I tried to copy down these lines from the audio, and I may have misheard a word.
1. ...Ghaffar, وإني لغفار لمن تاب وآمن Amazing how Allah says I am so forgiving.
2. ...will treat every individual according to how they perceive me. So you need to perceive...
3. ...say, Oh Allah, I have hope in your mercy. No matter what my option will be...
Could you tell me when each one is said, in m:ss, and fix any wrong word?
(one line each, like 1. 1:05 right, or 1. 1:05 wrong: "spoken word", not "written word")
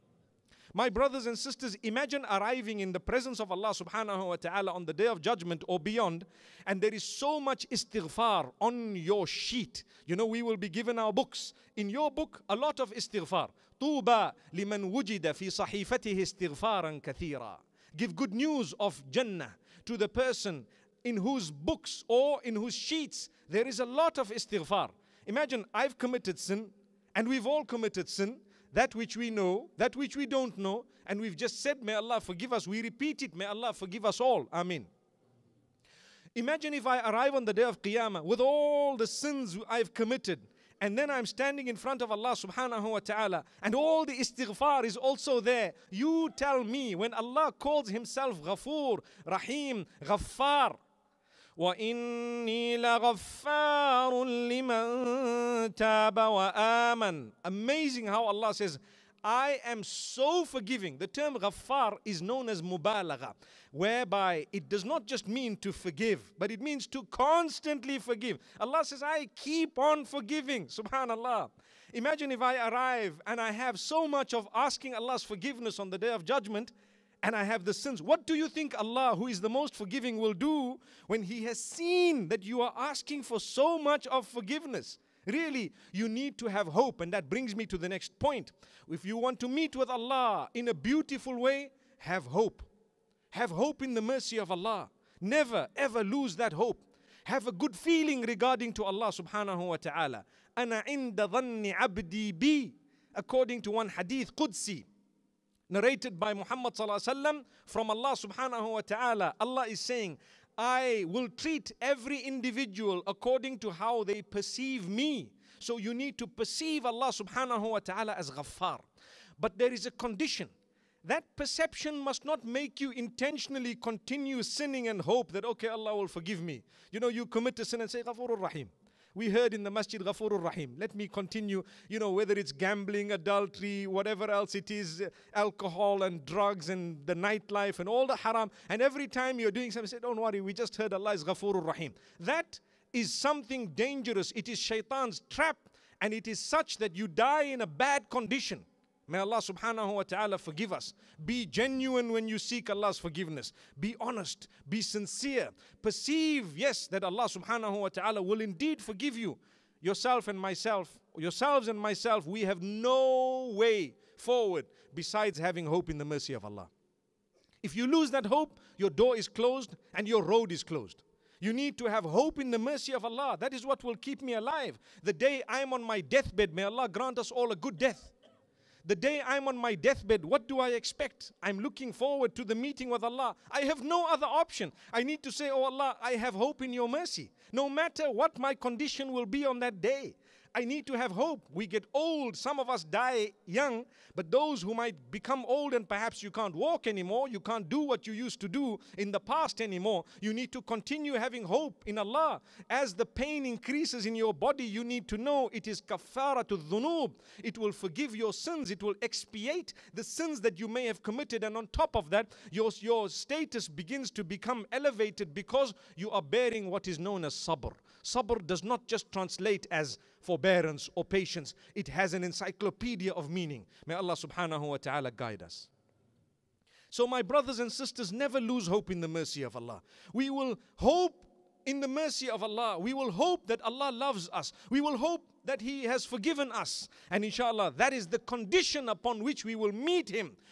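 1. 0:50 right
2. 1:51 right
3. 3:05 wrong: "condition", not "option".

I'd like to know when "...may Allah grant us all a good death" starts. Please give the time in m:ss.
2:56.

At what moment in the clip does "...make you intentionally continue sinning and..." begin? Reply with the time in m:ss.
2:02.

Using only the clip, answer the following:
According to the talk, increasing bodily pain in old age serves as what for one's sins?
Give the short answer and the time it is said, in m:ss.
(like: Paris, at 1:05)
kafara, at 3:25.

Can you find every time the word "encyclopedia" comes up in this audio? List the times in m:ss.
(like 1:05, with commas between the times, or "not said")
3:42.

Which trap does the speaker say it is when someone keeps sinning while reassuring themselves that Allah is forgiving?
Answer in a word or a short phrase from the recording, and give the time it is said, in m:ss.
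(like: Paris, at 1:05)
Shaitan's trap, at 2:24.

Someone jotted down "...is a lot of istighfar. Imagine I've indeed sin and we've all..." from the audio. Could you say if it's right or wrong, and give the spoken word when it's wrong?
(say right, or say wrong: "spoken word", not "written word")
wrong: "committed", not "indeed".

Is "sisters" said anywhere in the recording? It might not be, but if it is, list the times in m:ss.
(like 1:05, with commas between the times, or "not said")
0:01, 3:47.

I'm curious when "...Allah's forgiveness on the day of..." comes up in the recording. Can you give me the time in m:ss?
1:14.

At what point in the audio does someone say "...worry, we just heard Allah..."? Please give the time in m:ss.
2:20.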